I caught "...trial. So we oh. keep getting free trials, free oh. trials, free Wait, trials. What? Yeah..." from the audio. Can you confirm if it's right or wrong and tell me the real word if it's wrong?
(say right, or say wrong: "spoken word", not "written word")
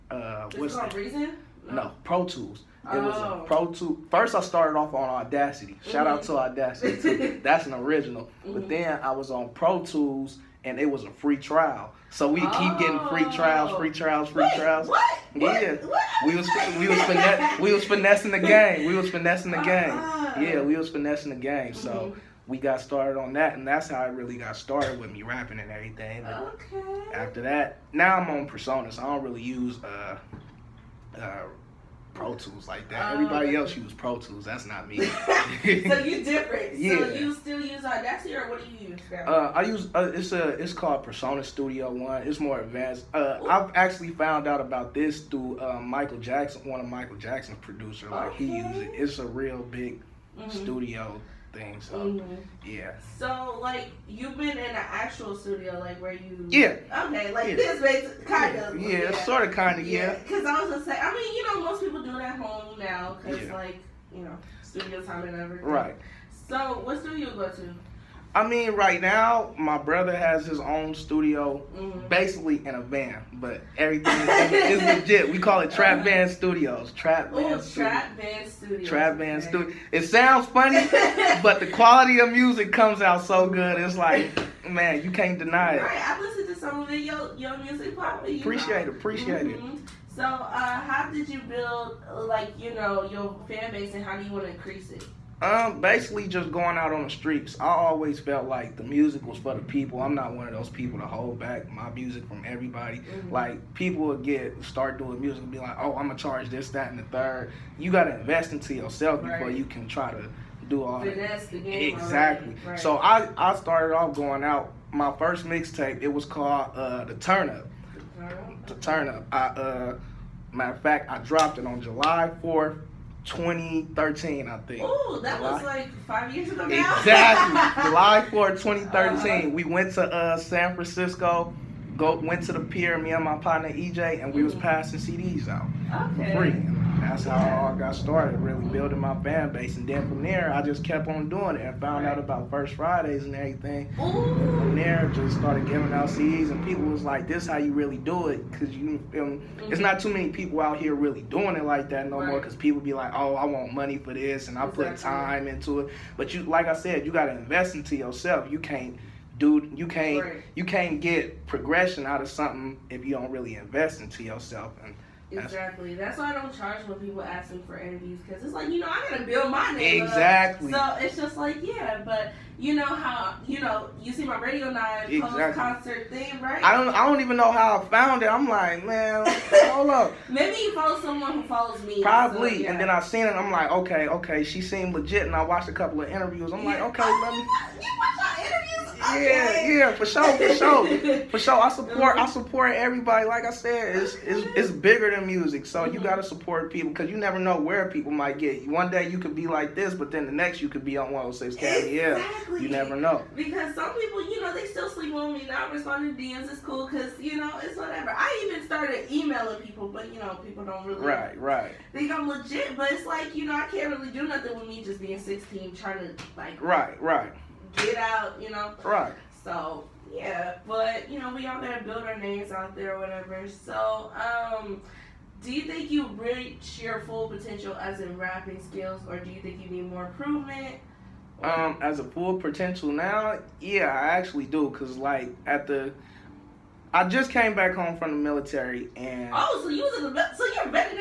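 right.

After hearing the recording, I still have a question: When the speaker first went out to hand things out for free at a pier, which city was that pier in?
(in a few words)
San Francisco.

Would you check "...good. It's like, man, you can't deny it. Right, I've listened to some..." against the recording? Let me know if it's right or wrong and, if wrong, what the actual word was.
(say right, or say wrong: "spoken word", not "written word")
right.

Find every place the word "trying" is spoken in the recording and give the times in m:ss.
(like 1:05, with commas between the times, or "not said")
3:35.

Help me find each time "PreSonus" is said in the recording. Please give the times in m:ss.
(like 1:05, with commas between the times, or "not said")
0:28, 0:41.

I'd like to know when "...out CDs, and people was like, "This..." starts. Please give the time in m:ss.
2:25.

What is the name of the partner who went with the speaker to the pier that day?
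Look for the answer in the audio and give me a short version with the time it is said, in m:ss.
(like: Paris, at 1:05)
EJ, at 2:13.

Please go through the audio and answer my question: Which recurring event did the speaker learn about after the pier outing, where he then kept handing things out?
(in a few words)
First Fridays.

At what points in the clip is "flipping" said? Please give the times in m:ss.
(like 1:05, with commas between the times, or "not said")
not said.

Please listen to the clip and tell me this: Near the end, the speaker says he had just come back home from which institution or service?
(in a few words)
the military.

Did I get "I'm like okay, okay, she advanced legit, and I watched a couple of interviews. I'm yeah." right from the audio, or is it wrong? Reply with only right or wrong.
wrong.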